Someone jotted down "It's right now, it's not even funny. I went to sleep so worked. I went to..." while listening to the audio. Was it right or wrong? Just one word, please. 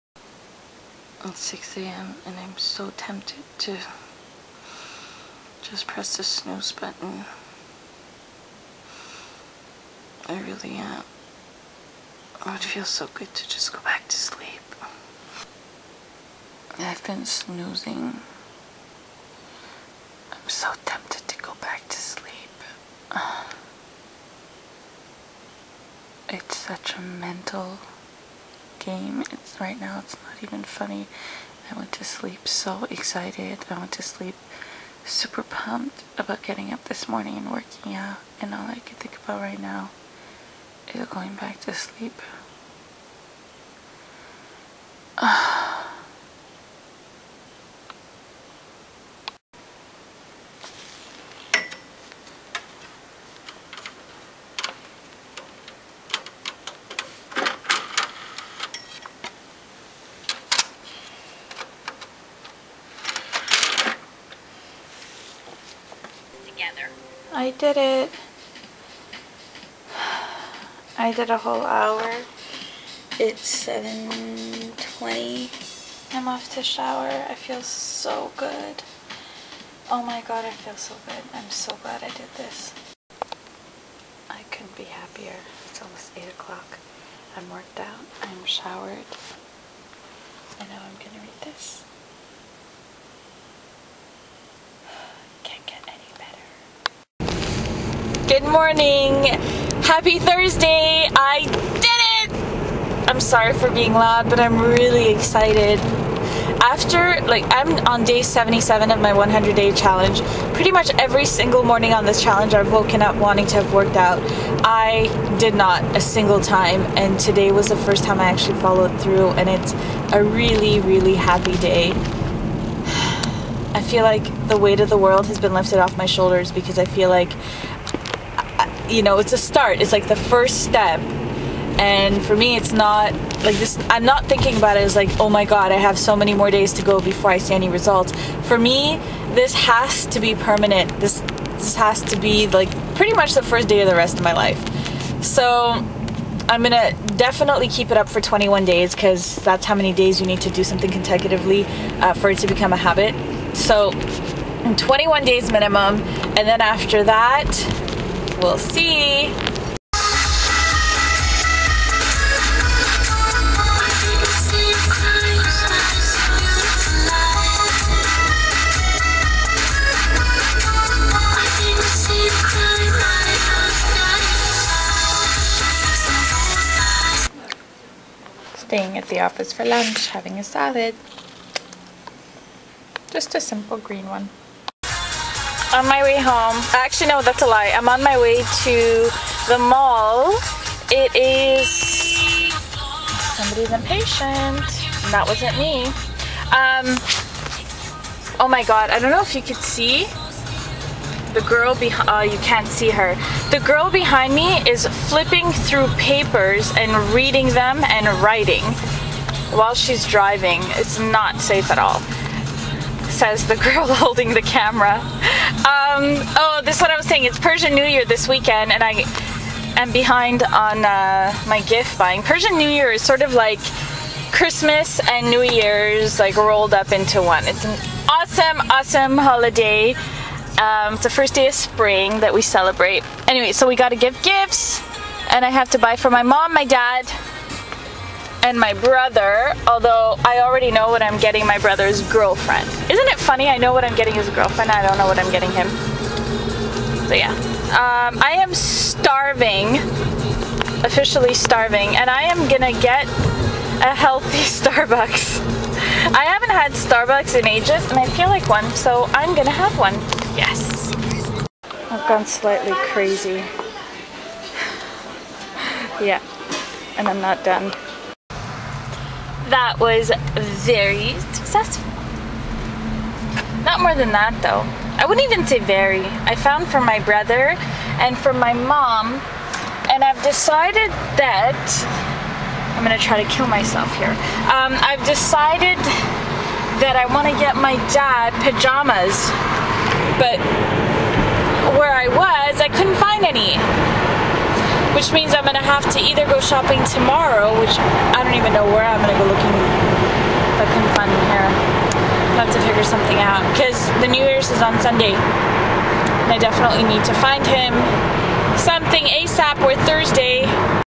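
wrong.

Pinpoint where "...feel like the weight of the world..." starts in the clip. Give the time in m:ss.
2:03.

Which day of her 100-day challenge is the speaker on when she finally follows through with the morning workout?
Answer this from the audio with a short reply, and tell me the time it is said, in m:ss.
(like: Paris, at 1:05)
77, at 1:48.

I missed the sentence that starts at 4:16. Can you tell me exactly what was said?
I haven't had Starbucks in ages, and I feel like one, so I'm gonna have one.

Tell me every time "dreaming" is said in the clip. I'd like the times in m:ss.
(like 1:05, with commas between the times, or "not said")
not said.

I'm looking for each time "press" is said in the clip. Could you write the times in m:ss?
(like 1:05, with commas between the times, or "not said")
0:05.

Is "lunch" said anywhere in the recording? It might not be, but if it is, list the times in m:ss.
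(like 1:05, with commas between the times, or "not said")
2:59.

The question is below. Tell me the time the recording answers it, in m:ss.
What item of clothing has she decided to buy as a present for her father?
4:48.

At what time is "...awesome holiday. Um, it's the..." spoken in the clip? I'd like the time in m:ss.
3:48.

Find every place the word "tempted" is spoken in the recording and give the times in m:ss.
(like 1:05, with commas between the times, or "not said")
0:02, 0:20.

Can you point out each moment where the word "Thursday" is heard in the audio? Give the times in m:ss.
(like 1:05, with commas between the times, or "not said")
1:40, 5:09.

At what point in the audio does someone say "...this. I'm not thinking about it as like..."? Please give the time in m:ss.
2:13.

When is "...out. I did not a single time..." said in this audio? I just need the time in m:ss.
1:53.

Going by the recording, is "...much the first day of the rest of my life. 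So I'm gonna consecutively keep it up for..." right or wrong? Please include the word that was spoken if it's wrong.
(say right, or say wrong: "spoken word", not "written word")
wrong: "definitely", not "consecutively".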